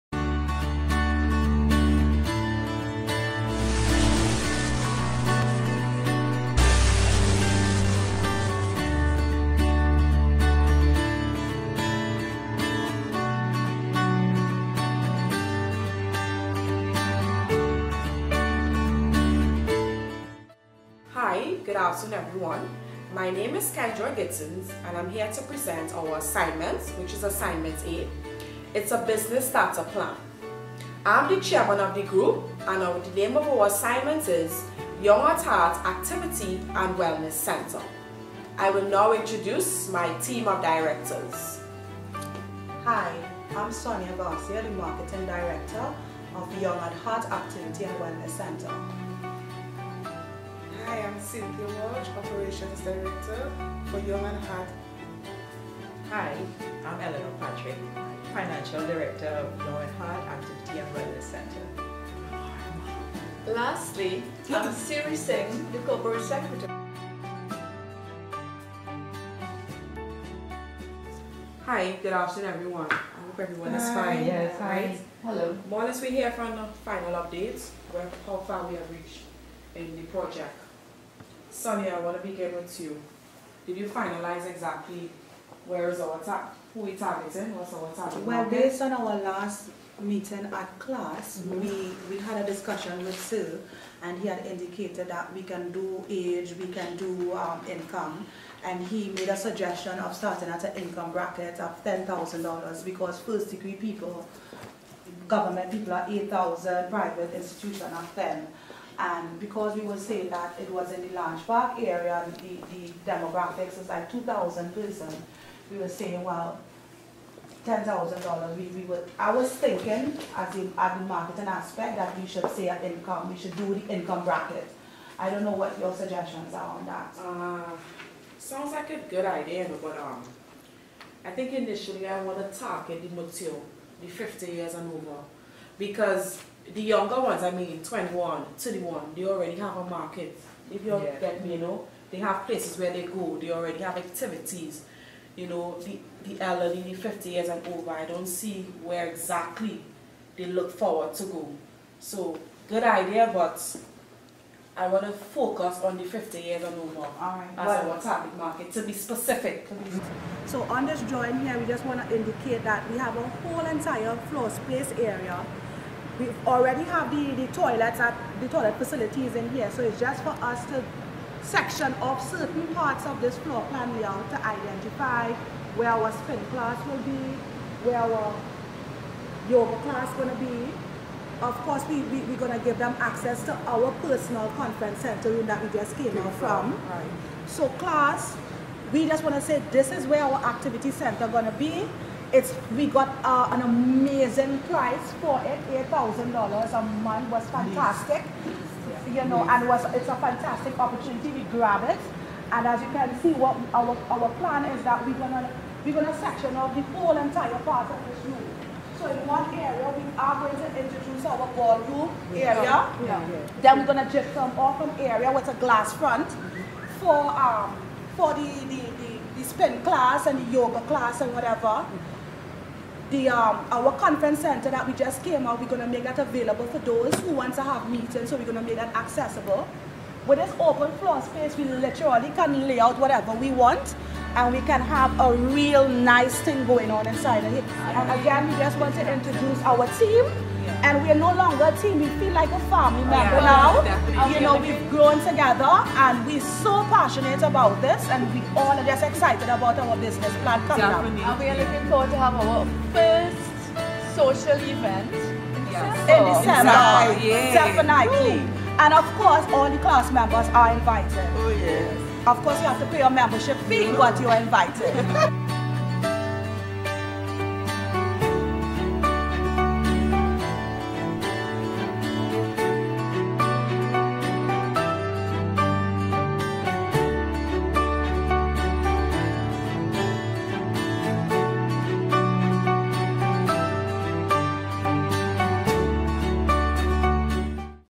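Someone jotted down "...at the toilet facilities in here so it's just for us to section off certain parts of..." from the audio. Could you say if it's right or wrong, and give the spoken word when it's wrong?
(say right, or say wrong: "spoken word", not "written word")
right.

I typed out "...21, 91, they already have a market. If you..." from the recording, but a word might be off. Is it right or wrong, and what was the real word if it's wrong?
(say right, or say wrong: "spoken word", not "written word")
wrong: "21", not "91".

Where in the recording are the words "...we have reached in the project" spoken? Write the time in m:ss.
1:18.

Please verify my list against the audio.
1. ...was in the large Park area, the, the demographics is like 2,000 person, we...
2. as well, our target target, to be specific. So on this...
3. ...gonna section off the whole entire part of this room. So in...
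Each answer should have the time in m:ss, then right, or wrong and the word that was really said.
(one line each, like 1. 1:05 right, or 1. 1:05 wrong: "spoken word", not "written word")
1. 1:50 right
2. 2:37 wrong: "market", not "target"
3. 3:25 right.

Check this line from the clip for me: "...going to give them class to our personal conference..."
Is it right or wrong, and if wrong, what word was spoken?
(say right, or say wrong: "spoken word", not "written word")
wrong: "access", not "class".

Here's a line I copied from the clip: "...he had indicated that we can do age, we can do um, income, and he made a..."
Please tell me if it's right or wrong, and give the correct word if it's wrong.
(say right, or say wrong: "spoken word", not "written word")
right.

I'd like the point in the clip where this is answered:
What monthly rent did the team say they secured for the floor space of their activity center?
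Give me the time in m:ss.
3:15.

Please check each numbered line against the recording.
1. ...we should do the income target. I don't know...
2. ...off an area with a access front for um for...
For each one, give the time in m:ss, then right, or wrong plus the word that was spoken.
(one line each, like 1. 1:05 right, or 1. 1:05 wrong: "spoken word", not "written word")
1. 2:03 wrong: "bracket", not "target"
2. 3:34 wrong: "glass", not "access".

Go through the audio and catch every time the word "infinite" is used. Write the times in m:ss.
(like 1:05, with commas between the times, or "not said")
not said.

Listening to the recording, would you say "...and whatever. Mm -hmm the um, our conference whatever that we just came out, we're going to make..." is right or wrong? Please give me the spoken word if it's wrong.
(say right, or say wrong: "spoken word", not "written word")
wrong: "center", not "whatever".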